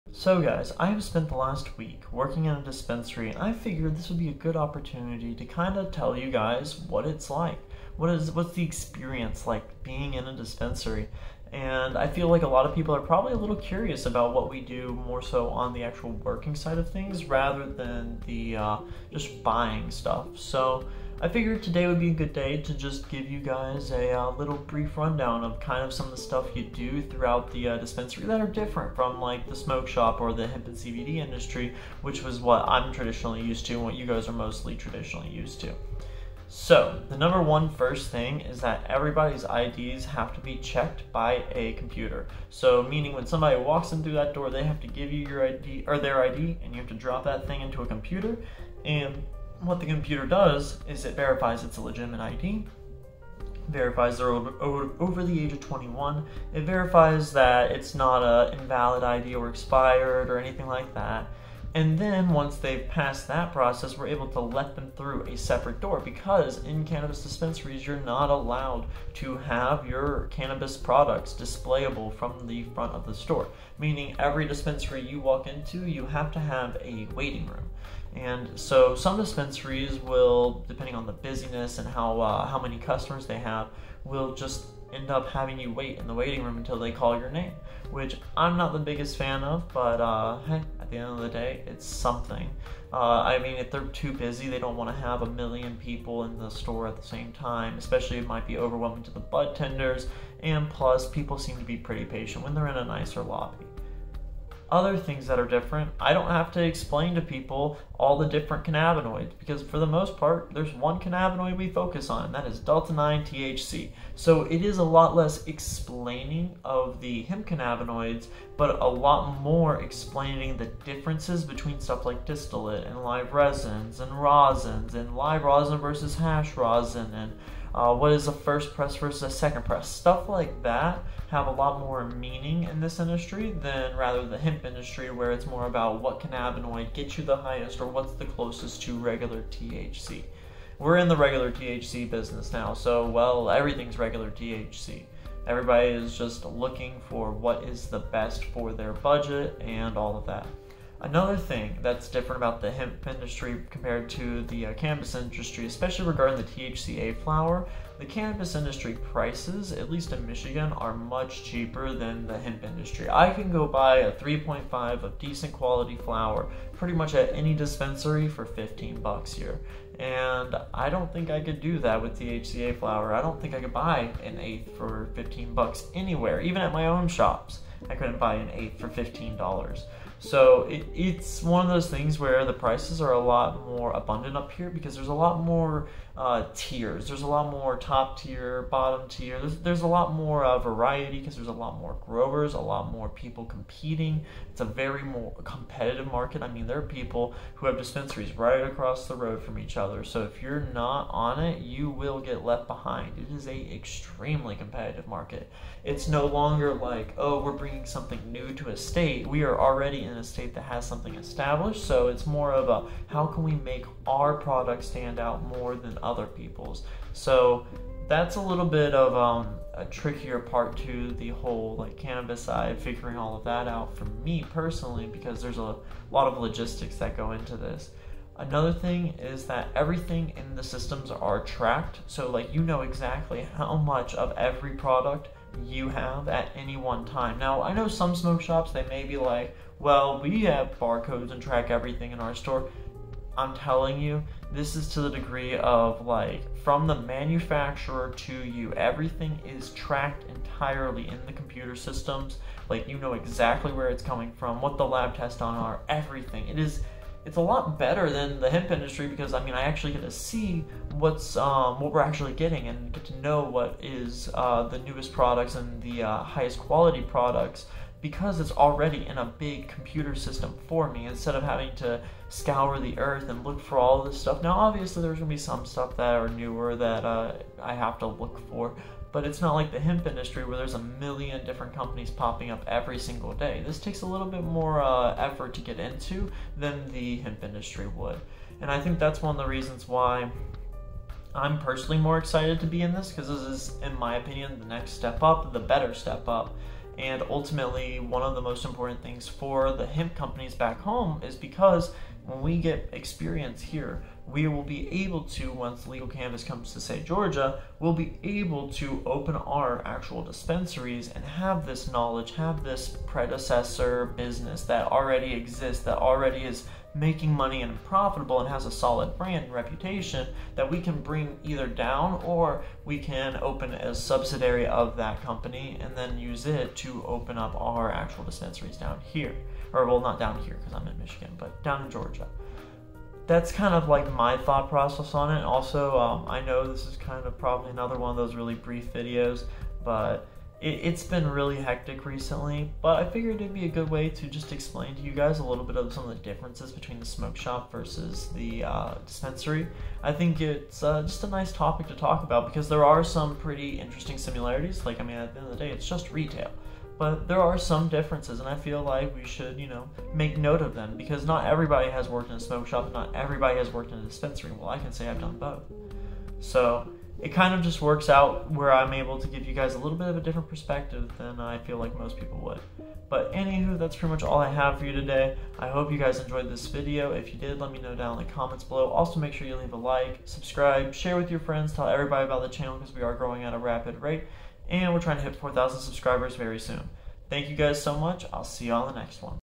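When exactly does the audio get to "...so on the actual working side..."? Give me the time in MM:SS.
00:15.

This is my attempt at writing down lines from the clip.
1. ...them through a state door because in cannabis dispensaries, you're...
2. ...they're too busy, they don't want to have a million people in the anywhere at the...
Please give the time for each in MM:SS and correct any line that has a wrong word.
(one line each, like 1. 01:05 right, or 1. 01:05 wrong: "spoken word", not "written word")
1. 01:04 wrong: "separate", not "state"
2. 01:33 wrong: "store", not "anywhere".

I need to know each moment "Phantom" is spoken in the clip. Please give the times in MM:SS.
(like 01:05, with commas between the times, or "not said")
not said.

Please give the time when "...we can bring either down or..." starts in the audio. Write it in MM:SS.
05:20.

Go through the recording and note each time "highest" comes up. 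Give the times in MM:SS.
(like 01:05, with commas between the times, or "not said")
02:17, 04:26.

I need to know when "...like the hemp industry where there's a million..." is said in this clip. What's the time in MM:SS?
04:39.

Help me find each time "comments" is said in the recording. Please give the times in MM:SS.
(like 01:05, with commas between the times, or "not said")
06:18.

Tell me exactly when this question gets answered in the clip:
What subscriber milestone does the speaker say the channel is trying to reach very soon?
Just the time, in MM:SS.
06:25.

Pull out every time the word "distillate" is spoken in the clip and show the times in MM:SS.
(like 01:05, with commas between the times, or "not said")
02:02.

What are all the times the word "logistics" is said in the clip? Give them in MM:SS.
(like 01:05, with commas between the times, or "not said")
03:46.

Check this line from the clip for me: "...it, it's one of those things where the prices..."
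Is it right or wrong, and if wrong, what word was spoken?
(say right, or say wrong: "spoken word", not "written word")
right.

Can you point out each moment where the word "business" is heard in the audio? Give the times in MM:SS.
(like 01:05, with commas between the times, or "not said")
02:22, 05:14.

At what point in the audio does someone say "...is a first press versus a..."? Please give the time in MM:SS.
02:08.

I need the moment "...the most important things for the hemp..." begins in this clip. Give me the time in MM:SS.
04:58.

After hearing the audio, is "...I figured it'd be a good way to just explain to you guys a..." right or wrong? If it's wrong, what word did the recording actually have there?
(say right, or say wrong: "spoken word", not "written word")
right.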